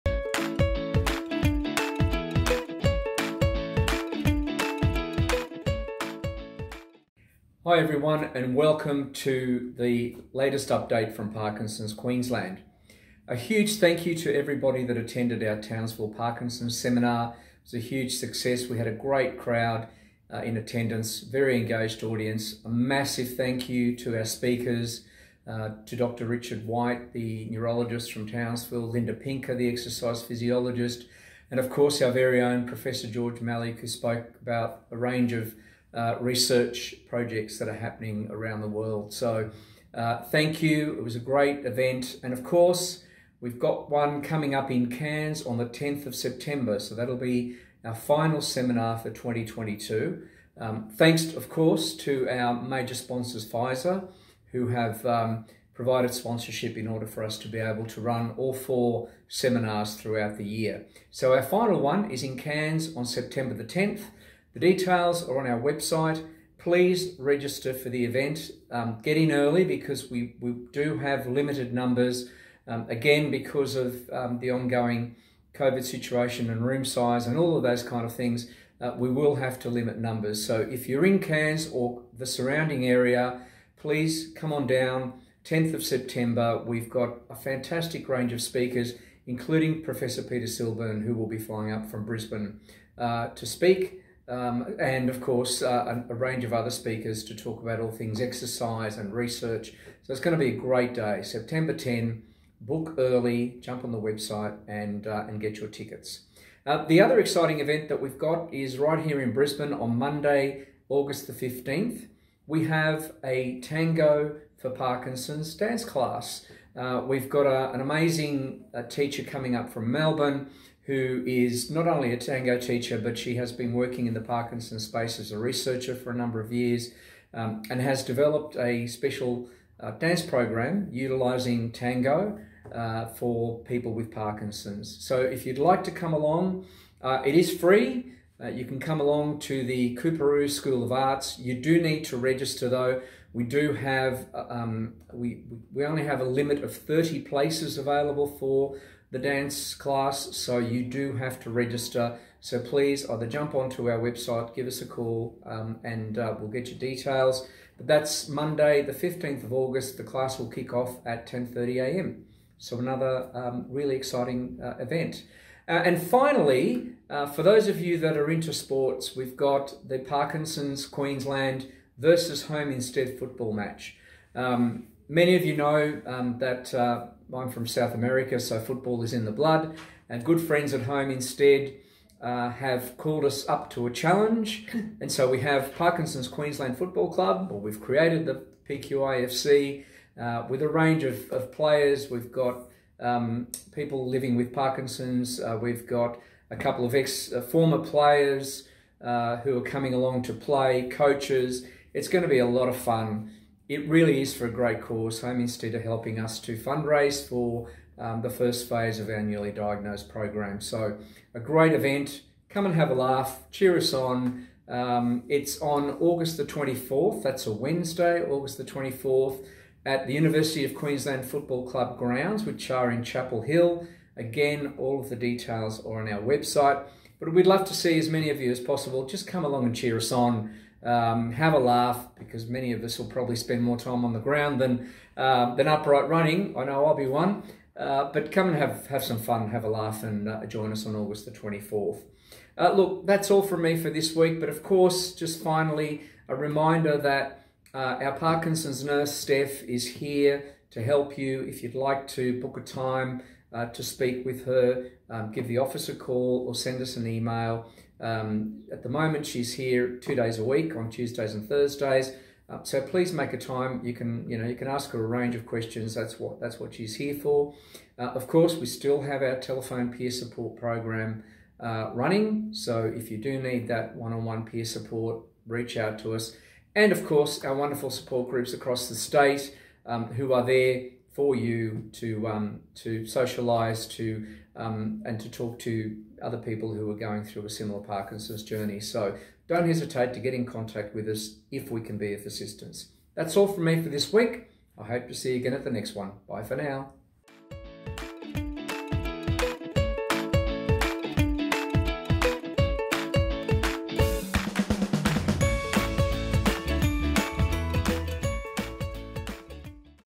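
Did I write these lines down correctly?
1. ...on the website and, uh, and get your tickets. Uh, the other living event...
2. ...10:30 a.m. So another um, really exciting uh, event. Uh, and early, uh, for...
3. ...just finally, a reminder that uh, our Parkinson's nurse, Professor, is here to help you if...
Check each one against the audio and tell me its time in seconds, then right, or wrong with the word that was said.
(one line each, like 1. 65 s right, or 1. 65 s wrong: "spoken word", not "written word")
1. 103 s wrong: "exciting", not "living"
2. 161 s wrong: "finally", not "early"
3. 245 s wrong: "Steph", not "Professor".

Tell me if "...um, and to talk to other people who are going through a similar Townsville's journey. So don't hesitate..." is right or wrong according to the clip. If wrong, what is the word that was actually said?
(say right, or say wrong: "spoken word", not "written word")
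wrong: "Parkinson", not "Townsville".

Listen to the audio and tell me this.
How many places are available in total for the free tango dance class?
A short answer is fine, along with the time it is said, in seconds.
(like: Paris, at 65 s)
30, at 146 s.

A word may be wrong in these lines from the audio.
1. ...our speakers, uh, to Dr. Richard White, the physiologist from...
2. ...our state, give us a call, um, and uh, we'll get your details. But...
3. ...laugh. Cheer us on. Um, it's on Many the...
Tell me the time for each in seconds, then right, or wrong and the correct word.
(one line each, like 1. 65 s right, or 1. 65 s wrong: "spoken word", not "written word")
1. 24 s wrong: "neurologist", not "physiologist"
2. 153 s wrong: "website", not "state"
3. 212 s wrong: "August", not "Many".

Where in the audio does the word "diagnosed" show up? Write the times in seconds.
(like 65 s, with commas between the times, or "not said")
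209 s.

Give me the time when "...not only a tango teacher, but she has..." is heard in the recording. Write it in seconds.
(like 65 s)
121 s.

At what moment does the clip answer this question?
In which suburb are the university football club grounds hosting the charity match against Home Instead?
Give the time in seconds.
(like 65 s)
223 s.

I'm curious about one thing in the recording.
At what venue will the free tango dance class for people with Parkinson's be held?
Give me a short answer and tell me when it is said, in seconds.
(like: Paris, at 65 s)
Coorparoo School of Arts, at 139 s.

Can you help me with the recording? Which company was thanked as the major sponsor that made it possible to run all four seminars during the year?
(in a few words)
Pfizer.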